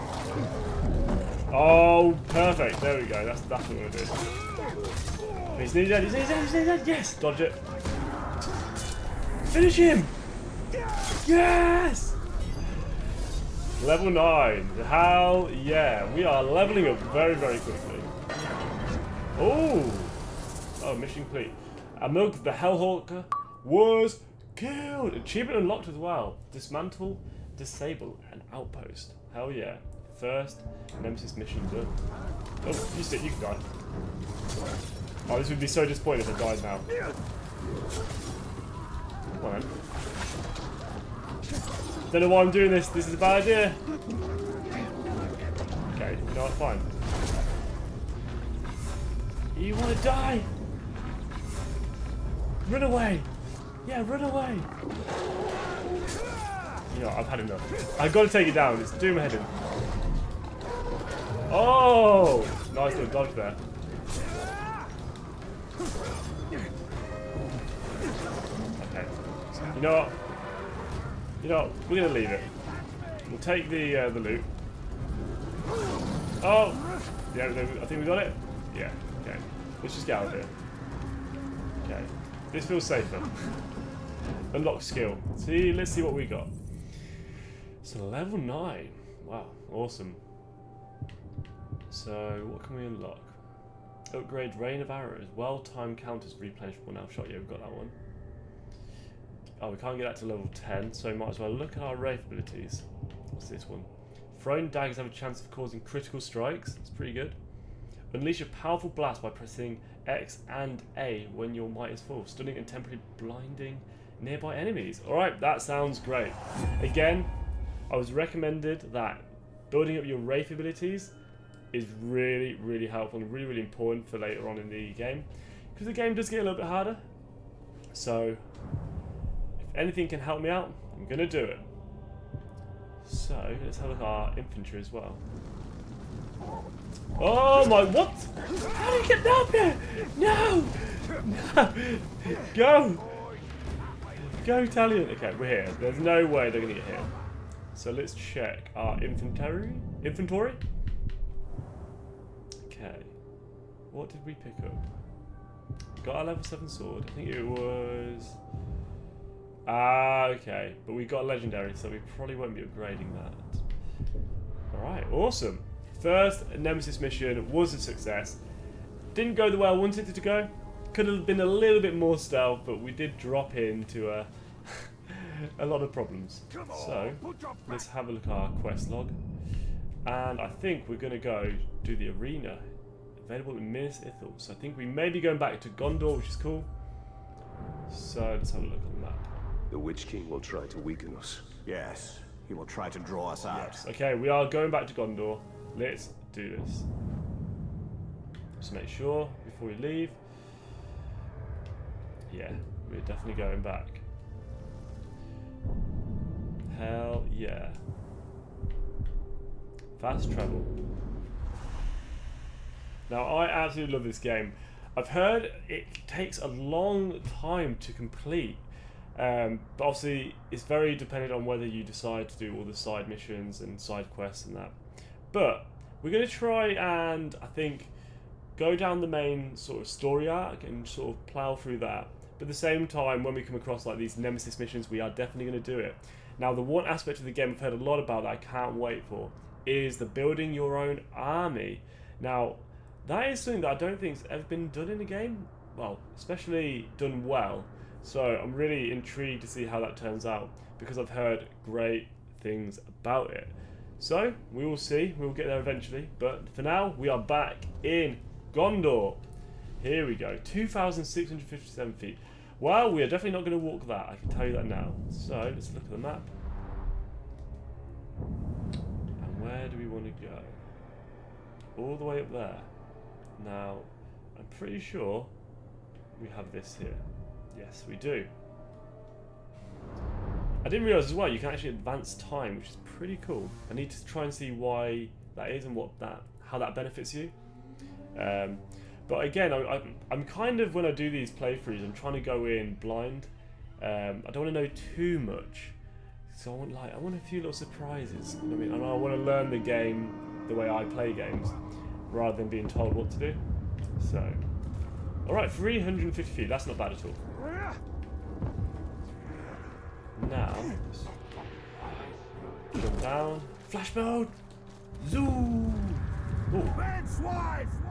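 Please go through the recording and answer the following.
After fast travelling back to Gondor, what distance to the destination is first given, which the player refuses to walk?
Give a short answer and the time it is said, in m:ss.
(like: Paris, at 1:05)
2,657 feet, at 4:20.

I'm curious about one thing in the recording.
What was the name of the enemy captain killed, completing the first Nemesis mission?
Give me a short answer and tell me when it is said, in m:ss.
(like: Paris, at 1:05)
Amilk the Hellhawker, at 0:22.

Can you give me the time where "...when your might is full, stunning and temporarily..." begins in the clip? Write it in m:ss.
1:51.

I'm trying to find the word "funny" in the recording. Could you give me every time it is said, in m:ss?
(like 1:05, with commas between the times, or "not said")
not said.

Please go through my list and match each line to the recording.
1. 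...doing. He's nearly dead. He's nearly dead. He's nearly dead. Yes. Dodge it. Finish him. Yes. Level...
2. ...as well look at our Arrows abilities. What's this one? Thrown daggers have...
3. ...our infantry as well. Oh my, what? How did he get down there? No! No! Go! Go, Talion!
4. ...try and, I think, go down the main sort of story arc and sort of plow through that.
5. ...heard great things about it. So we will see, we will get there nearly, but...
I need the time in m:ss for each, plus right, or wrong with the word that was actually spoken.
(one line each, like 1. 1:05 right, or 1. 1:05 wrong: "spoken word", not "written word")
1. 0:03 right
2. 1:41 wrong: "Wraith", not "Arrows"
3. 2:14 right
4. 3:46 right
5. 4:11 wrong: "eventually", not "nearly".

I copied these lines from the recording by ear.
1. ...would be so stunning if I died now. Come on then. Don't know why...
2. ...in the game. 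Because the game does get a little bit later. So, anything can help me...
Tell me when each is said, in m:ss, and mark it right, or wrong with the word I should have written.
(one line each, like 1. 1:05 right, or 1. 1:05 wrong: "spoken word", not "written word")
1. 0:35 wrong: "disappointing", not "stunning"
2. 2:04 wrong: "harder", not "later".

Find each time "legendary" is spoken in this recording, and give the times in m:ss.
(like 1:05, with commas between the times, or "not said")
2:41.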